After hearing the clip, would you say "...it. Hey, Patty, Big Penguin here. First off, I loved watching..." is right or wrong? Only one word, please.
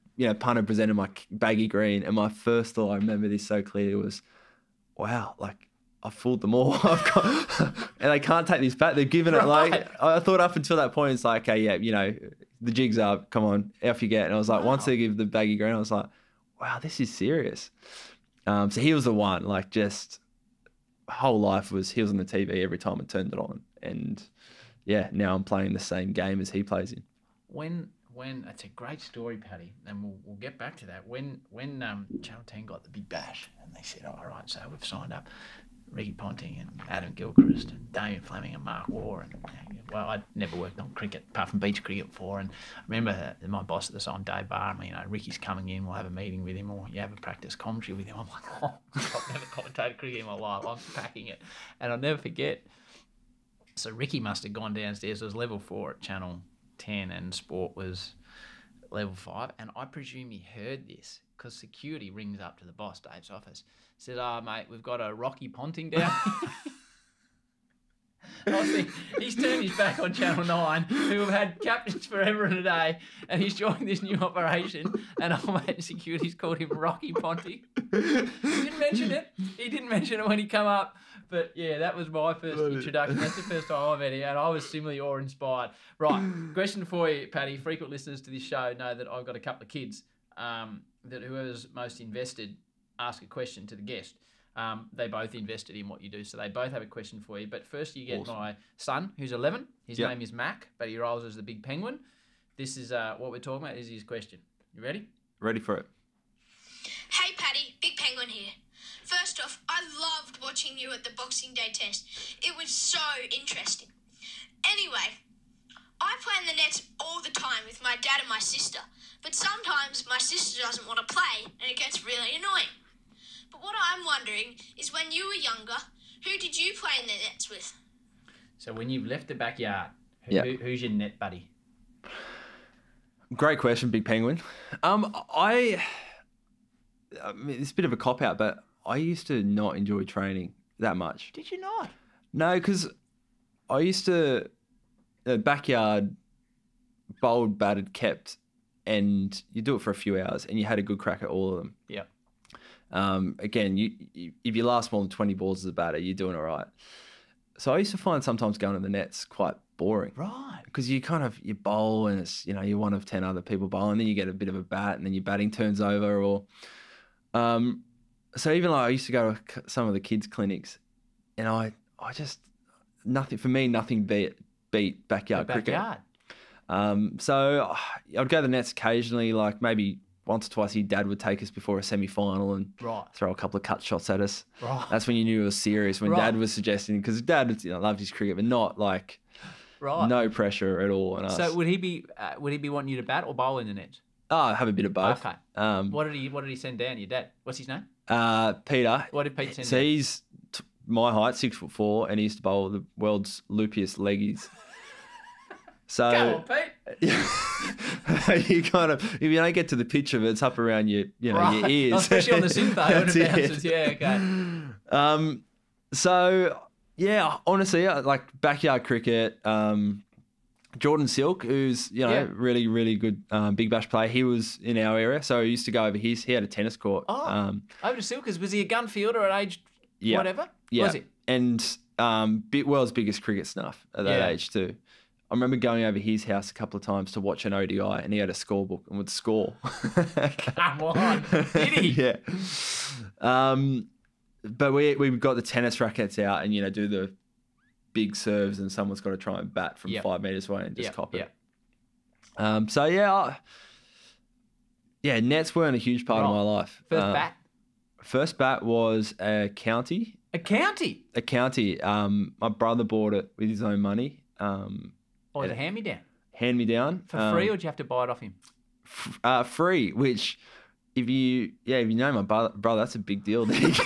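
right.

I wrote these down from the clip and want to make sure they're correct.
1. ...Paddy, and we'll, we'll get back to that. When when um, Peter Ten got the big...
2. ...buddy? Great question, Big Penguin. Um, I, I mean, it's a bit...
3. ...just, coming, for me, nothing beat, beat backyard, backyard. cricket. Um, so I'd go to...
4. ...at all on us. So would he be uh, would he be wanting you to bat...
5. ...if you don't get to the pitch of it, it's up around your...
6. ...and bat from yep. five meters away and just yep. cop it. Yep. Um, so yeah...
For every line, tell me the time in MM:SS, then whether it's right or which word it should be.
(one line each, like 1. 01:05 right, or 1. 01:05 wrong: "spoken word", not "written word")
1. 00:29 wrong: "Channel", not "Peter"
2. 02:11 right
3. 02:52 wrong: "nothing", not "coming"
4. 03:10 right
5. 03:29 right
6. 04:09 right.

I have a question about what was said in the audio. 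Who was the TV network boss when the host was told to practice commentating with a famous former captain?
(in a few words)
Dave Barham.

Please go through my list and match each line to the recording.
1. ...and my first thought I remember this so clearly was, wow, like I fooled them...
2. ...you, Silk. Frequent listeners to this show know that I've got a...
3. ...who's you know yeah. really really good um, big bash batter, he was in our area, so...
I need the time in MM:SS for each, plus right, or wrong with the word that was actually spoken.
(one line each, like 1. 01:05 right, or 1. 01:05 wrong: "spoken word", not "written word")
1. 00:02 right
2. 01:27 wrong: "Paddy", not "Silk"
3. 03:41 wrong: "player", not "batter".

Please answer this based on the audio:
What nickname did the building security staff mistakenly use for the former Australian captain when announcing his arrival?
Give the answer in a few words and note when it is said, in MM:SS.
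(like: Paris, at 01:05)
Rocky Ponting, at 01:05.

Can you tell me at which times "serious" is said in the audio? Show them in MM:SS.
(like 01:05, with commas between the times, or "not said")
00:17, 03:05.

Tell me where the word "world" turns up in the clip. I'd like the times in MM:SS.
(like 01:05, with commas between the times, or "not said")
03:22, 03:52.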